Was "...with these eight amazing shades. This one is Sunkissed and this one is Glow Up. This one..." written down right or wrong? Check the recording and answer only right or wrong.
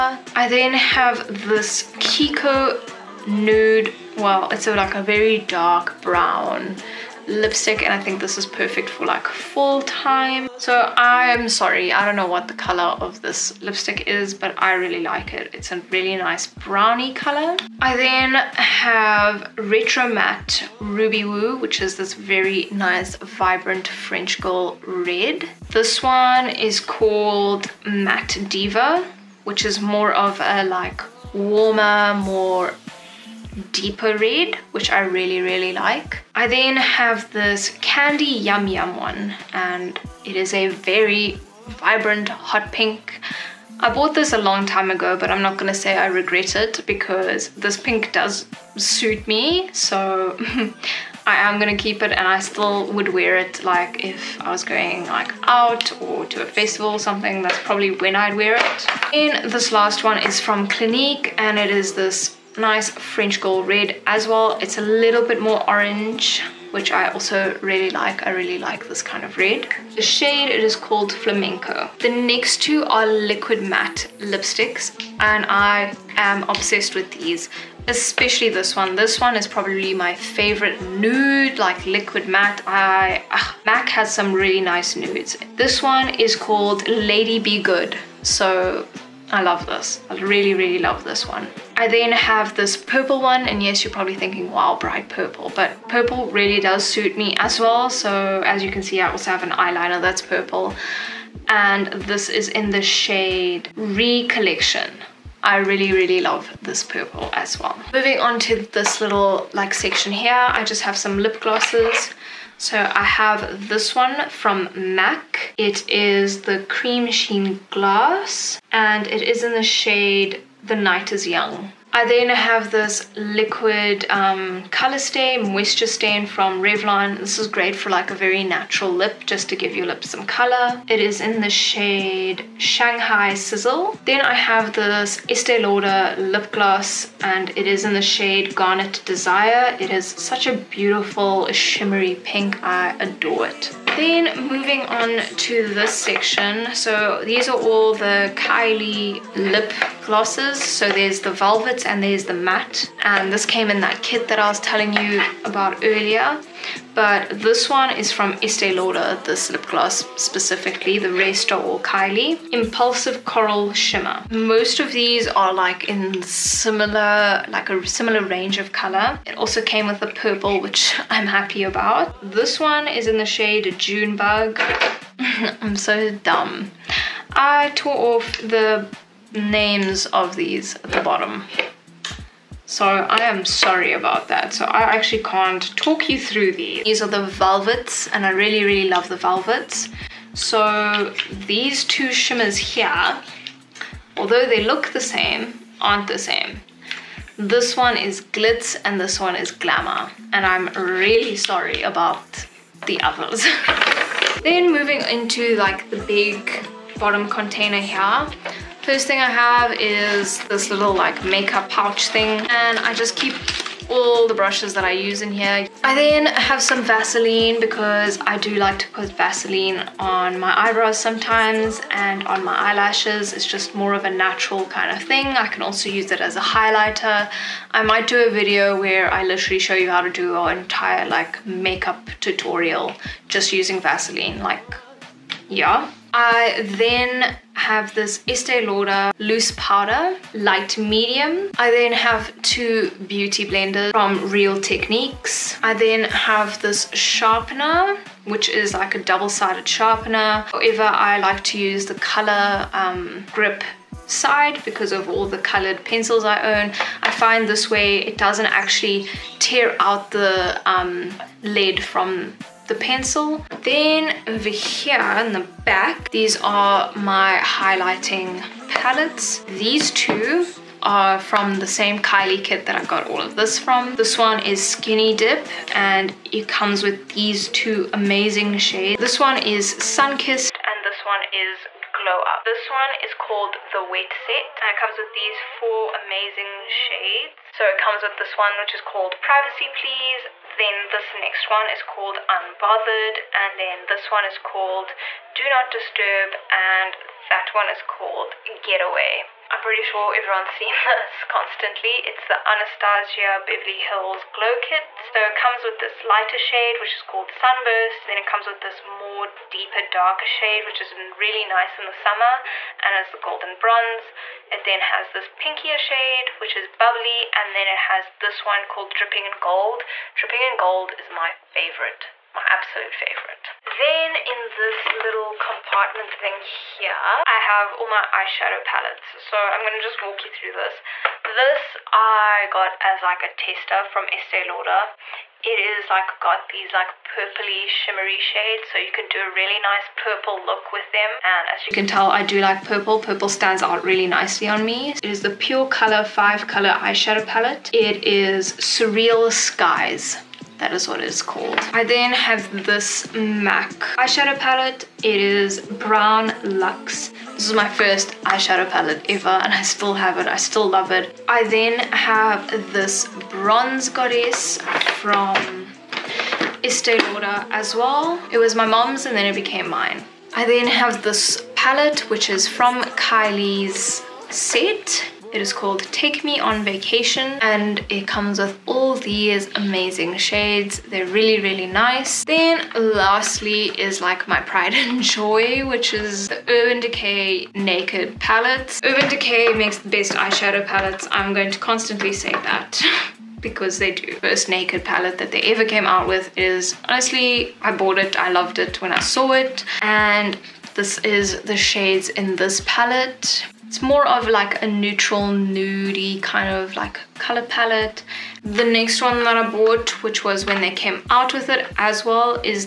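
wrong.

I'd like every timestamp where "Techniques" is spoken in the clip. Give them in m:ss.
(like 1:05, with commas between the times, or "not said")
4:04.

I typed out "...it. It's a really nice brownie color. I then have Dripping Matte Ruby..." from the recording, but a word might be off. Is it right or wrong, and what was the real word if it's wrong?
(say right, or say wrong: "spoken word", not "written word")
wrong: "Retro", not "Dripping".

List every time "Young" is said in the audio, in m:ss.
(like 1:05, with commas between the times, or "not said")
2:01.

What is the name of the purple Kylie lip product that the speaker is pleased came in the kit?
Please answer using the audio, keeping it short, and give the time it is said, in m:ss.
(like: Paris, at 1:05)
June Bug, at 2:53.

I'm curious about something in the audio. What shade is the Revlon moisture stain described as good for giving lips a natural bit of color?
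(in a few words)
Shanghai Sizzle.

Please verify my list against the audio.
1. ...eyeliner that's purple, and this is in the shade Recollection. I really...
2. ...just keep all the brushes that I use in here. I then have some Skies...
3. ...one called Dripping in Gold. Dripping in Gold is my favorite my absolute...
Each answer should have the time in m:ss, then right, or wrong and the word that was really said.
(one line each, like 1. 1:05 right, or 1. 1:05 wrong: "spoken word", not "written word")
1. 1:39 right
2. 3:32 wrong: "Vaseline", not "Skies"
3. 5:18 right.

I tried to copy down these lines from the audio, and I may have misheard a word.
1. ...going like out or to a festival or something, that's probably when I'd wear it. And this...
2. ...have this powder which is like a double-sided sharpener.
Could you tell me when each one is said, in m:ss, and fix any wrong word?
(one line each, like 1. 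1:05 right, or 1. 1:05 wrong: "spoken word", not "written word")
1. 0:54 right
2. 4:06 wrong: "sharpener", not "powder".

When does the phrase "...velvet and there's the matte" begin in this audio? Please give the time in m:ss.
2:31.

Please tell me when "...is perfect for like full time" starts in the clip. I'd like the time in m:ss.
0:08.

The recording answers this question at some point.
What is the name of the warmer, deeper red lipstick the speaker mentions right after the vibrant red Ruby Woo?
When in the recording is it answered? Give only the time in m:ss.
0:27.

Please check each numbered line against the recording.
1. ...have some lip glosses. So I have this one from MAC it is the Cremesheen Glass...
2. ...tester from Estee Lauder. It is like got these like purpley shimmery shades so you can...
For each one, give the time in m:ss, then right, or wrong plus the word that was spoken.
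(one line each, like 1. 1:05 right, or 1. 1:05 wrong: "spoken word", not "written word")
1. 1:50 right
2. 5:33 right.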